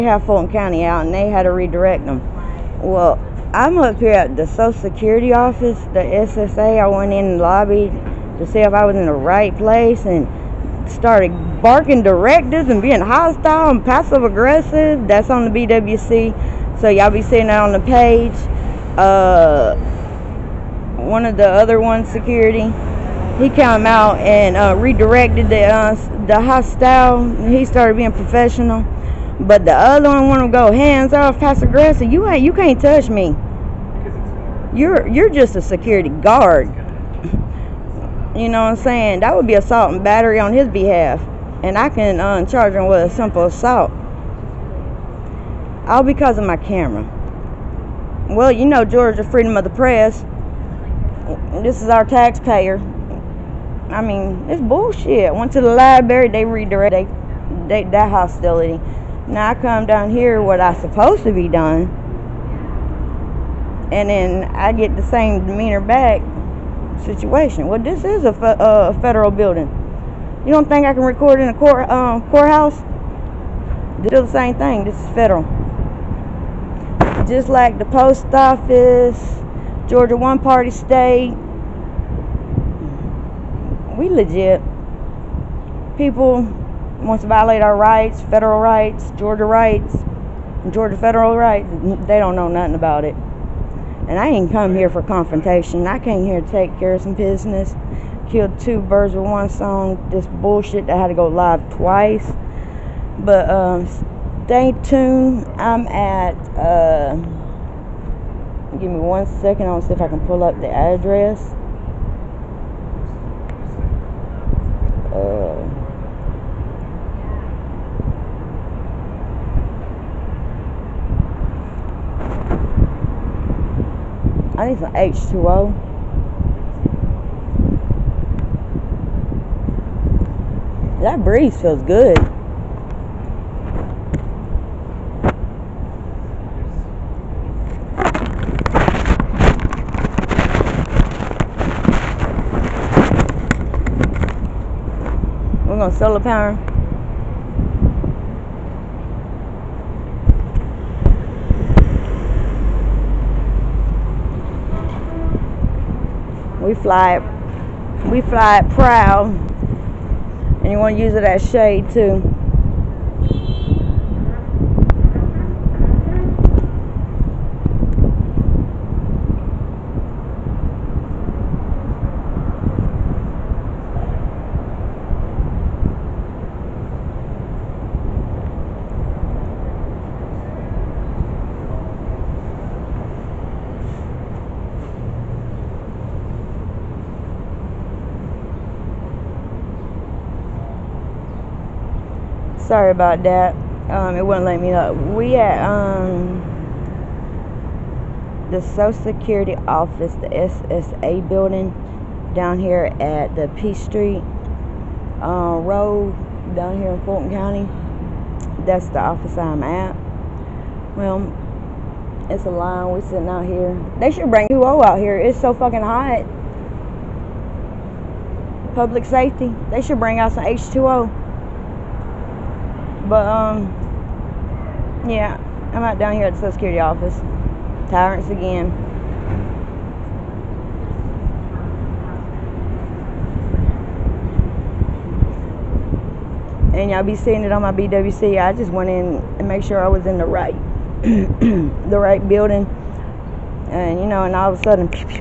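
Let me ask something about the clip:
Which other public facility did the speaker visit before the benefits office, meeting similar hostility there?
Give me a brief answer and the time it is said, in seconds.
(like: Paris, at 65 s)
The library, at 55 s.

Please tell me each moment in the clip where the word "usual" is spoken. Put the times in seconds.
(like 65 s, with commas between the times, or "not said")
not said.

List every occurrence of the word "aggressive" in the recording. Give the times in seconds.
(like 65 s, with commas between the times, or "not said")
14 s, 31 s.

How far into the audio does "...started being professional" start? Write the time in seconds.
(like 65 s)
27 s.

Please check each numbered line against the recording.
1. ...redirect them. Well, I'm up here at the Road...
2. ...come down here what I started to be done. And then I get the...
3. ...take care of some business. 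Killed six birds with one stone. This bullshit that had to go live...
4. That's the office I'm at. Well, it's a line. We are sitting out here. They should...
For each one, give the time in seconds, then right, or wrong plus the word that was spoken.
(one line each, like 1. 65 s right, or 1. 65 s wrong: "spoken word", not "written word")
1. 1 s wrong: "Social", not "Road"
2. 59 s wrong: "supposed", not "started"
3. 96 s wrong: "two", not "six"
4. 208 s right.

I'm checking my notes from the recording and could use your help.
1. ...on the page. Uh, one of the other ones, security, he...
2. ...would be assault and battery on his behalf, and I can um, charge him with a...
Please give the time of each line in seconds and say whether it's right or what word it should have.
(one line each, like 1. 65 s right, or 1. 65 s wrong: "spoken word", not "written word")
1. 17 s right
2. 39 s right.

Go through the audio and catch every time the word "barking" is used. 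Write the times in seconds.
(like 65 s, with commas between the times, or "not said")
11 s.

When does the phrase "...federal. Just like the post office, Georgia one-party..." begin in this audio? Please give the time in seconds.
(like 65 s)
75 s.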